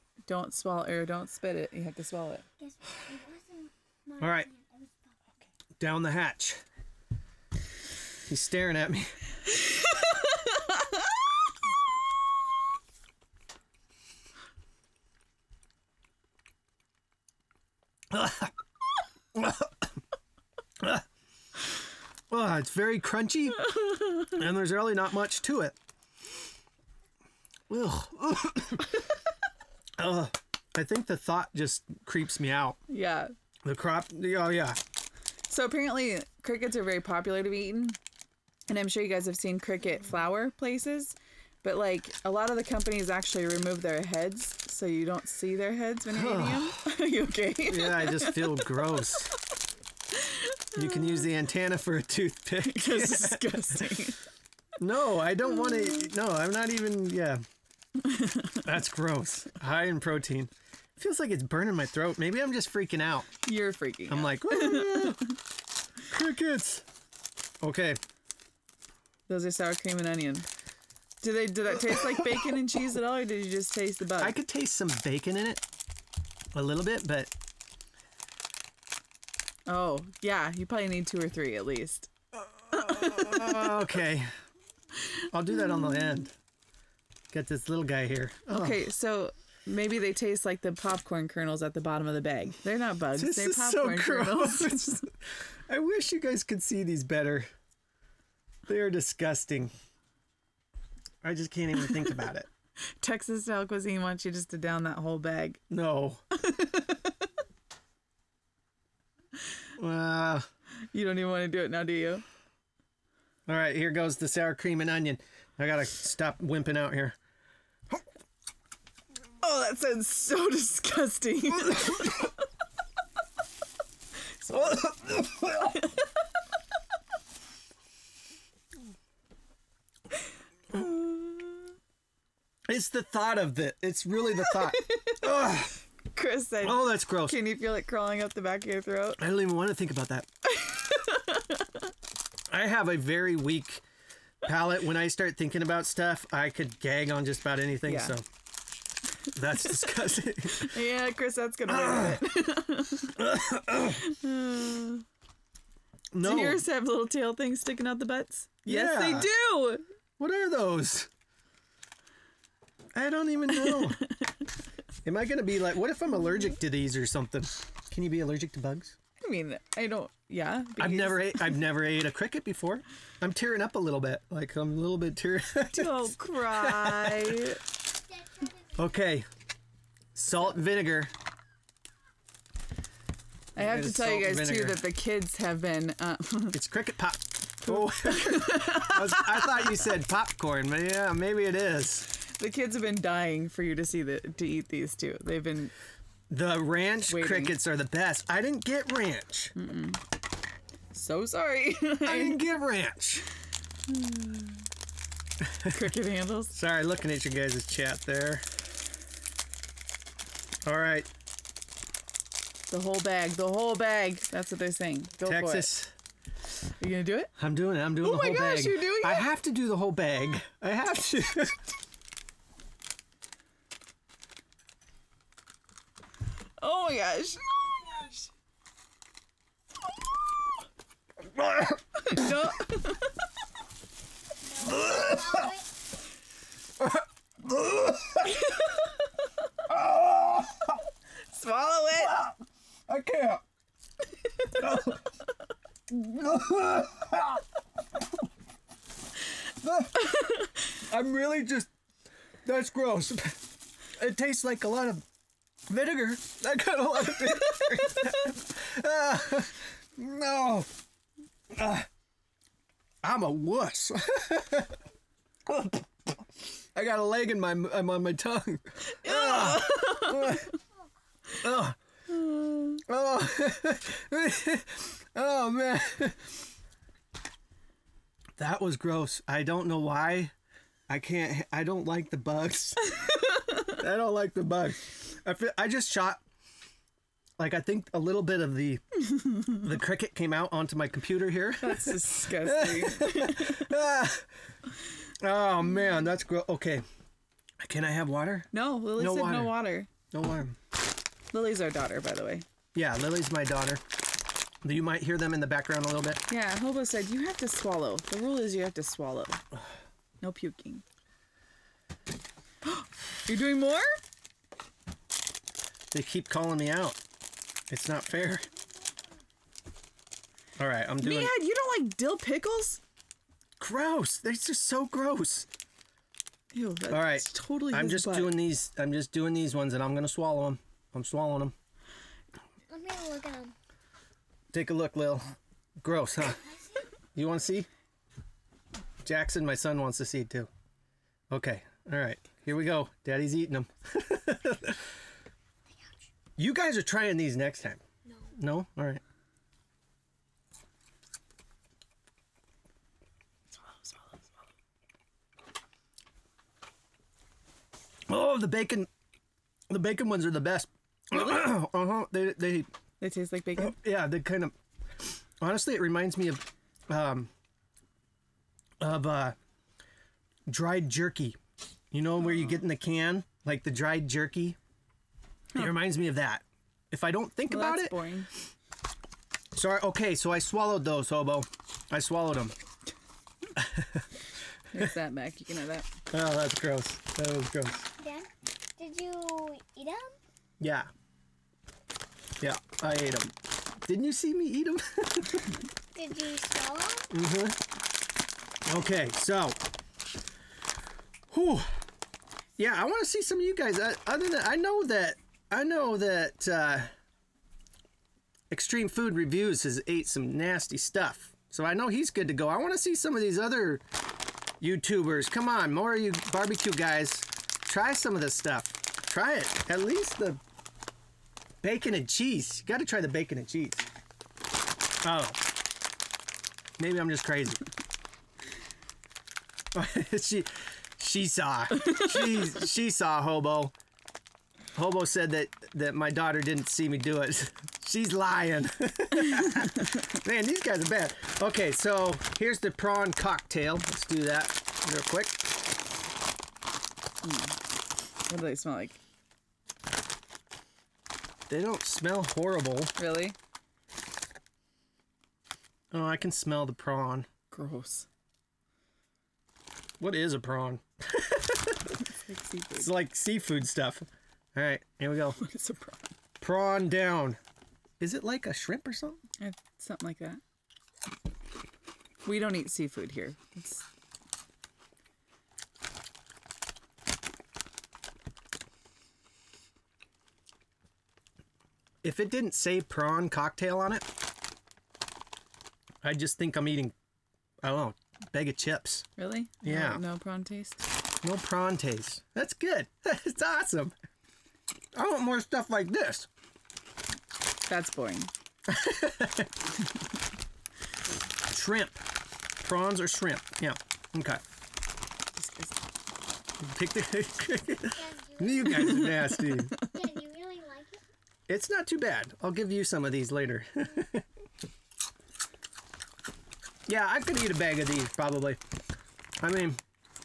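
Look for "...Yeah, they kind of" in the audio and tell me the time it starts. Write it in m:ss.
6:03.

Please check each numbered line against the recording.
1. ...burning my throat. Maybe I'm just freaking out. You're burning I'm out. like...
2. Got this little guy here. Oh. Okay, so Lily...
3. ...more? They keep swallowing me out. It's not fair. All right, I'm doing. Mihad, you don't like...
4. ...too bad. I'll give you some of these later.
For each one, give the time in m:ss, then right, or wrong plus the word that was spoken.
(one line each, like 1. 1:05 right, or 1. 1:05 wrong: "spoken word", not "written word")
1. 1:01 wrong: "freaking", not "burning"
2. 1:27 wrong: "Maybe", not "Lily"
3. 5:13 wrong: "calling", not "swallowing"
4. 8:31 right.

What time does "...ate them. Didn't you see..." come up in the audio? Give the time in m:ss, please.
6:32.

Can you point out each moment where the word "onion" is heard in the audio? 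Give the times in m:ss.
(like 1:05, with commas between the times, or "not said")
1:10, 1:54.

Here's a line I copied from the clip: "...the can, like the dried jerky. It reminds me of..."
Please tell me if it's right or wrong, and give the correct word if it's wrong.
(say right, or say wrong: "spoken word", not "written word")
right.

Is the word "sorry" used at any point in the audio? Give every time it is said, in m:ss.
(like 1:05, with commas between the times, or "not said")
3:21, 3:26, 6:19.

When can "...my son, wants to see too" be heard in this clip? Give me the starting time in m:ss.
5:39.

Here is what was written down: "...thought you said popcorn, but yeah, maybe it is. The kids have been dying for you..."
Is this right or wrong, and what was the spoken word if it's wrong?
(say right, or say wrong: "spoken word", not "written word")
right.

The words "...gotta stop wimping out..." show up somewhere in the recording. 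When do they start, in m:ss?
1:55.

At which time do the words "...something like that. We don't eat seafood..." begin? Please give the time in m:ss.
7:49.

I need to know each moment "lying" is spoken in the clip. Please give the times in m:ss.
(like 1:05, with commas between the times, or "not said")
7:18.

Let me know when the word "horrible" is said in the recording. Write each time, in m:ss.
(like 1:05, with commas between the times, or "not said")
7:32.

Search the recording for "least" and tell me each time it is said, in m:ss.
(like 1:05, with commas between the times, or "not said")
1:21, 6:59.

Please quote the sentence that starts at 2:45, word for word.
Am I going to be like, what if I'm allergic to these or something?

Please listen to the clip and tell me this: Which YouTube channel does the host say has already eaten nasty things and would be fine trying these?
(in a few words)
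Extreme Food Reviews.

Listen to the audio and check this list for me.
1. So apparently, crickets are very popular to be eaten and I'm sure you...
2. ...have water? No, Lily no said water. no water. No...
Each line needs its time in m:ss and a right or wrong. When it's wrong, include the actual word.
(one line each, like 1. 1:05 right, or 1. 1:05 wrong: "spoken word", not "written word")
1. 0:35 right
2. 4:57 right.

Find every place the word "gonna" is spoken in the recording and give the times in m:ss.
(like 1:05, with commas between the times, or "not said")
2:31, 3:36, 5:29.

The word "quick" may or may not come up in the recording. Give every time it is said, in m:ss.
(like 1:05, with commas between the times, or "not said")
7:25.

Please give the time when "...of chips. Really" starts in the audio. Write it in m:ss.
8:08.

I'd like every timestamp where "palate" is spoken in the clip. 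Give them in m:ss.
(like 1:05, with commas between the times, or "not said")
2:24.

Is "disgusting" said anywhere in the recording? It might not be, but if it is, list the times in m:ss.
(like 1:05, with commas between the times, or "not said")
0:53, 1:38, 2:00, 2:29, 4:51.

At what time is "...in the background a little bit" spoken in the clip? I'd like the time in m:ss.
5:05.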